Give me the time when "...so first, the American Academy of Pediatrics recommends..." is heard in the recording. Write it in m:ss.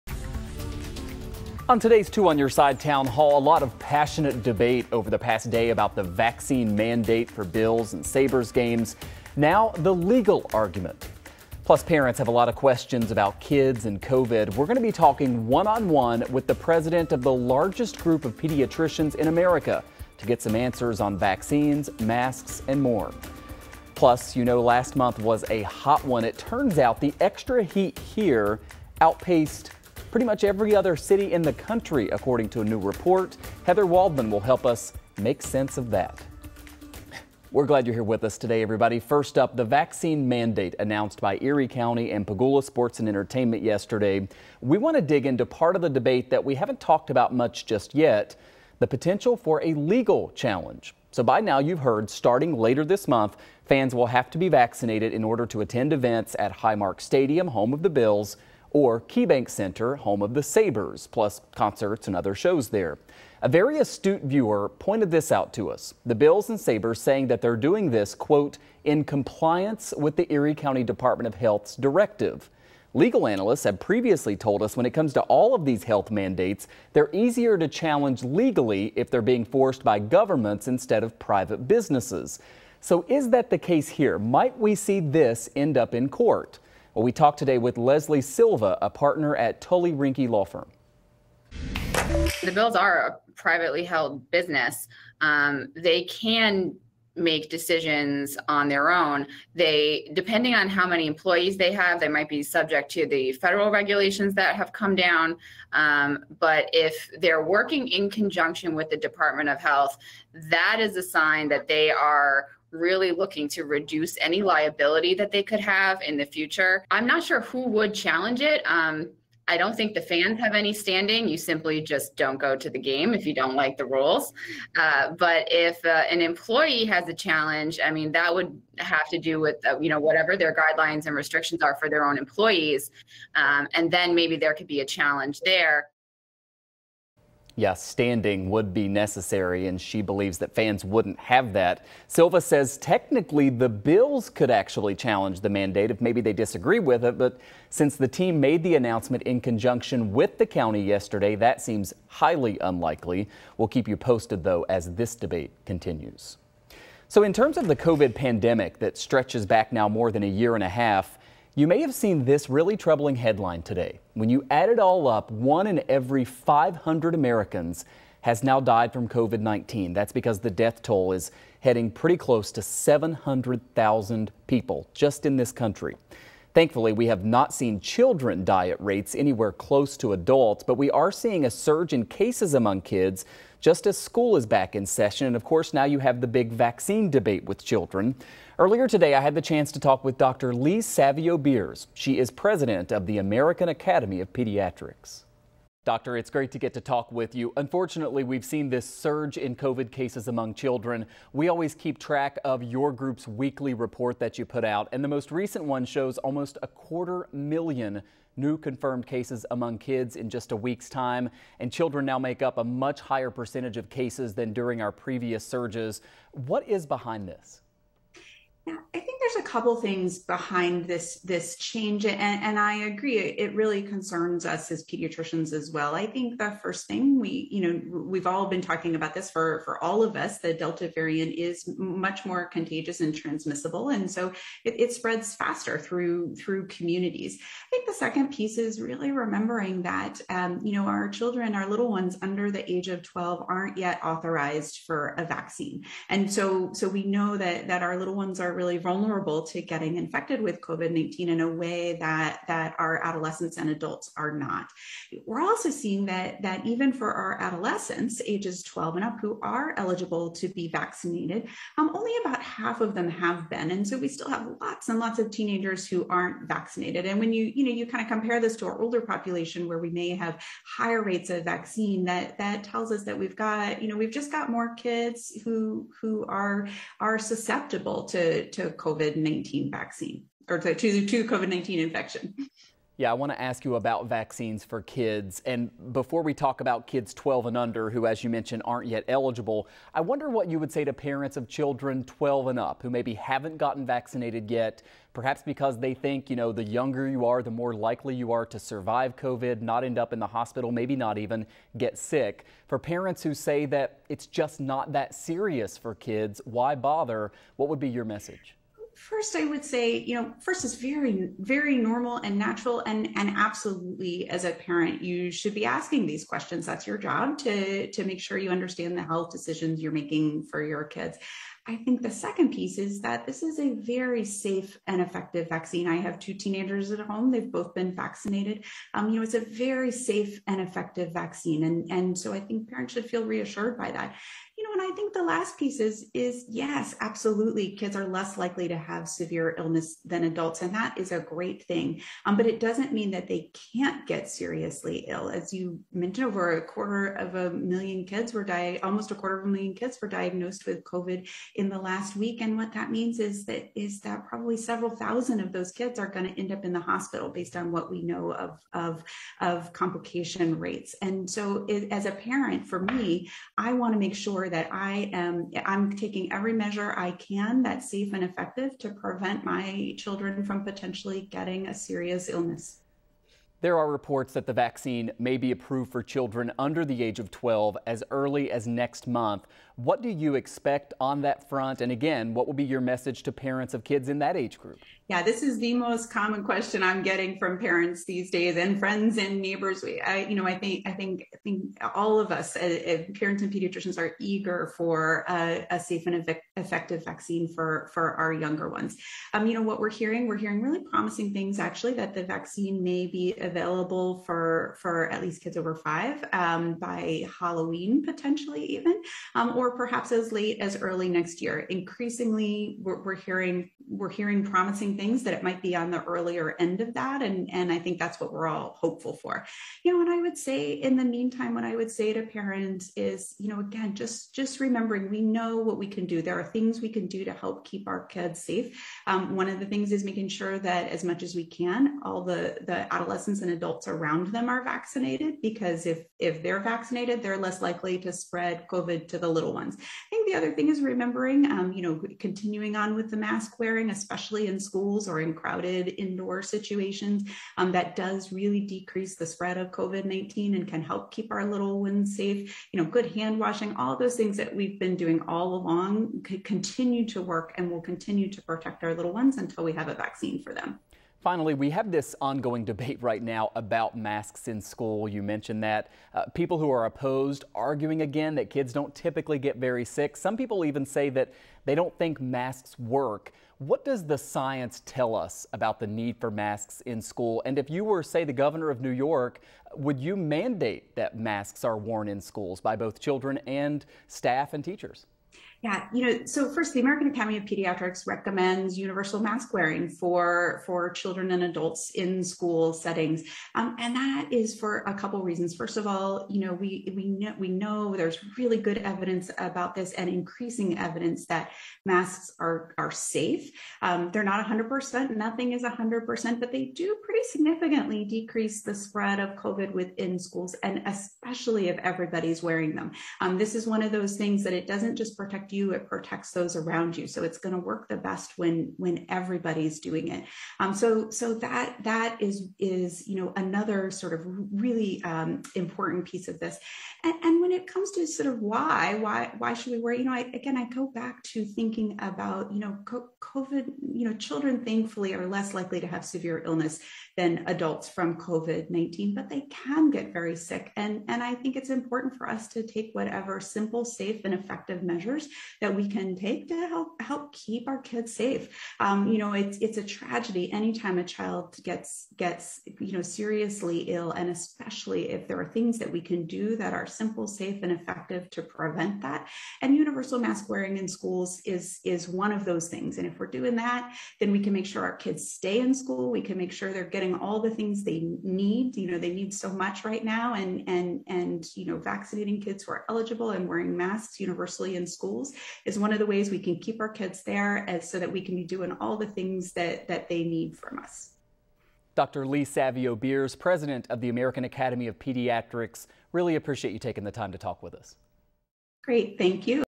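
8:06.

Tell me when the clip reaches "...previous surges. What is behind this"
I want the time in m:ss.
3:34.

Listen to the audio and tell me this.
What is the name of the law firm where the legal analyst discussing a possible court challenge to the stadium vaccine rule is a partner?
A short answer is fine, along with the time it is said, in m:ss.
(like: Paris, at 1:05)
Tully Rinckey, at 1:29.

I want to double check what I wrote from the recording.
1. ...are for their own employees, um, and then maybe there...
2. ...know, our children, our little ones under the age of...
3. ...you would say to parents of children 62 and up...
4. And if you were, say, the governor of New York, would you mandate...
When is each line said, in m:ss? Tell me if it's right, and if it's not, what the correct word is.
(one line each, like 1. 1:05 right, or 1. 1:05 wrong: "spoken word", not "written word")
1. 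2:11 right
2. 4:00 right
3. 4:50 wrong: "12", not "62"
4. 7:57 right.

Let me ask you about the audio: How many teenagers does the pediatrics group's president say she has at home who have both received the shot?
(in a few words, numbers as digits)
2.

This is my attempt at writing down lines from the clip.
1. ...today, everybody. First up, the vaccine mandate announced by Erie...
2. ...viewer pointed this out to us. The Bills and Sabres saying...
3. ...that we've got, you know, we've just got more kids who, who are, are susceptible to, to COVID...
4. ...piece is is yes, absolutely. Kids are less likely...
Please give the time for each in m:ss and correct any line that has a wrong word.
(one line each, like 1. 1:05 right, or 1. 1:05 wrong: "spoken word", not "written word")
1. 0:38 right
2. 1:04 right
3. 4:33 right
4. 5:35 right.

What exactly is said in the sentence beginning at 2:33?
We'll keep you posted, though, as this debate continues.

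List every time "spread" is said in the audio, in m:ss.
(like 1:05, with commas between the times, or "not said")
3:54, 7:18, 7:29, 8:28.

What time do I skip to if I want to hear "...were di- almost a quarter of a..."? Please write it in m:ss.
5:48.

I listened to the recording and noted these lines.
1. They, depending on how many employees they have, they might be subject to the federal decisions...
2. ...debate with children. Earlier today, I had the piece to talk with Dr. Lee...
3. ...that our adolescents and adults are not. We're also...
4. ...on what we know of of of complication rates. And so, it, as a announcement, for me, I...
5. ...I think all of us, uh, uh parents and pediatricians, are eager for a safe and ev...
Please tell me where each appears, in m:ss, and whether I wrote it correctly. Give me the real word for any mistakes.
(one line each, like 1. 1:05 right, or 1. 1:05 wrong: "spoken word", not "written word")
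1. 1:39 wrong: "regulations", not "decisions"
2. 3:07 wrong: "chance", not "piece"
3. 4:12 right
4. 5:57 wrong: "parent", not "announcement"
5. 6:31 right.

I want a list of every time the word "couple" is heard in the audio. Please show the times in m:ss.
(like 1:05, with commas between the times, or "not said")
3:39, 8:14.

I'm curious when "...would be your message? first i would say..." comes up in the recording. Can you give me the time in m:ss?
5:07.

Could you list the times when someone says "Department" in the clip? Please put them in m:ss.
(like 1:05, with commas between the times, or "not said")
1:10, 1:48.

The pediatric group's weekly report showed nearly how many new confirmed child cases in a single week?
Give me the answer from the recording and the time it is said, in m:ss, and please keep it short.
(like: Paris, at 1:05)
a quarter million, at 3:26.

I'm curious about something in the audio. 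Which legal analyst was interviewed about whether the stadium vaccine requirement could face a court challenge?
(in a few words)
Leslie Silva.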